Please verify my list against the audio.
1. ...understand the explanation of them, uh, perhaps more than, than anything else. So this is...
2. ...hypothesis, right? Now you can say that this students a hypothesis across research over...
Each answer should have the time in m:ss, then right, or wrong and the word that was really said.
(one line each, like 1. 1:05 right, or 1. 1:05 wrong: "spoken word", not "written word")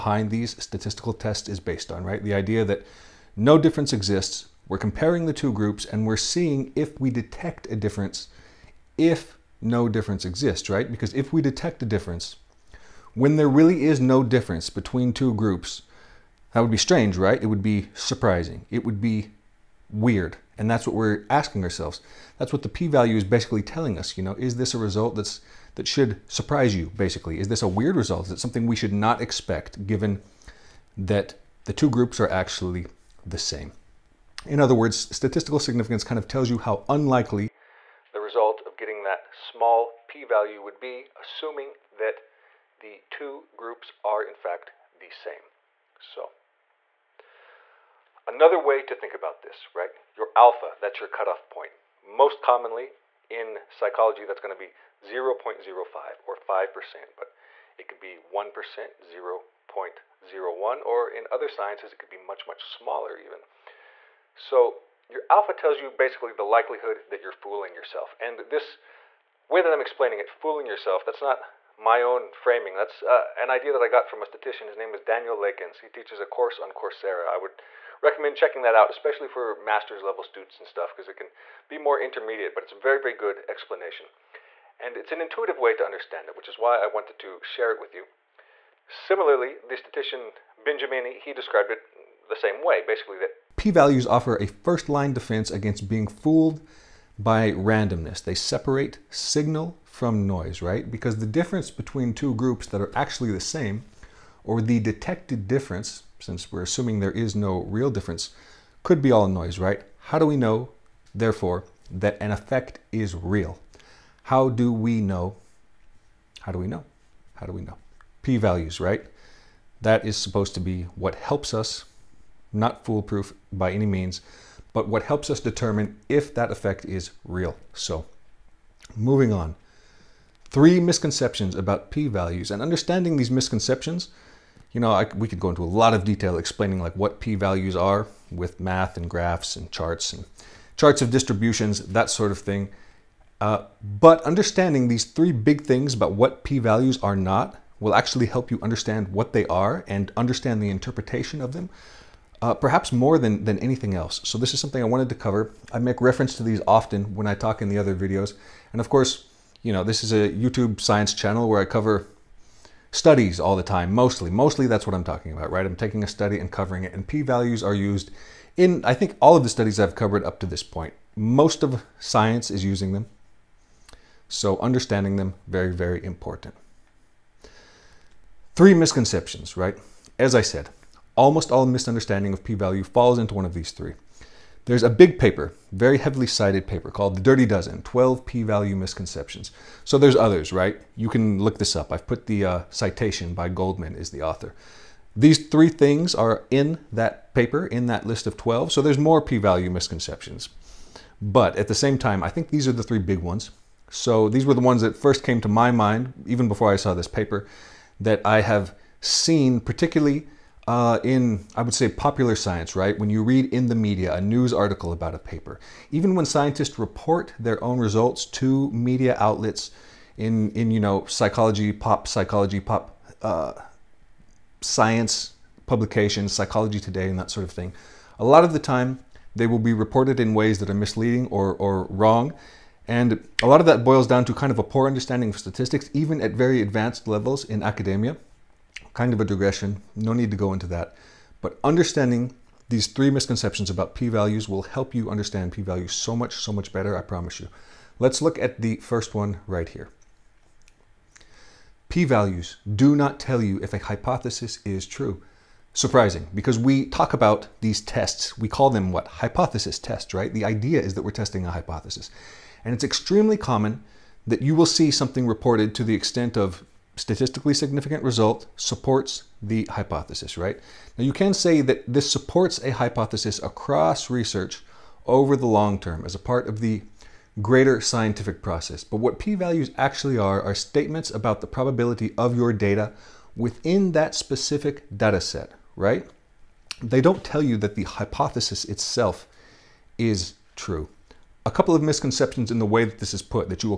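1. 2:30 wrong: "interpretation", not "explanation"
2. 4:29 wrong: "supports", not "students".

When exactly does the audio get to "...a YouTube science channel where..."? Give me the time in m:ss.
2:40.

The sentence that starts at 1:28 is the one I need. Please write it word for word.
Similarly, the statistician Benjamini he described it the same way, basically that p-values offer a first-line defense against being fooled by randomness.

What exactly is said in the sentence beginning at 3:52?
And a lot of that boils down to kind of a poor understanding of statistics, even at very advanced levels in academia.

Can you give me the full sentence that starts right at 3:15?
These three things are in that paper, in that list of 12, so there's more p-value misconceptions.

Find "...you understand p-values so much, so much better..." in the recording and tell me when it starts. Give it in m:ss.
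4:04.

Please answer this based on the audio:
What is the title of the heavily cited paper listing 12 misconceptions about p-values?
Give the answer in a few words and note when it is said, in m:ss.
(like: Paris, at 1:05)
The Dirty Dozen, at 3:07.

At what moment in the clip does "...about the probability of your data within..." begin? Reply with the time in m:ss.
4:41.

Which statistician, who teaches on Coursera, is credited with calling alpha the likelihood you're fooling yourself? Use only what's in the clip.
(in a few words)
Daniel Lakens.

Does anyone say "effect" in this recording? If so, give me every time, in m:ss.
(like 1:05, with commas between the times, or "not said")
1:52, 2:06.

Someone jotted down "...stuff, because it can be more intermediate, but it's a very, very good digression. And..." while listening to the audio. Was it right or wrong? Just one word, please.
wrong.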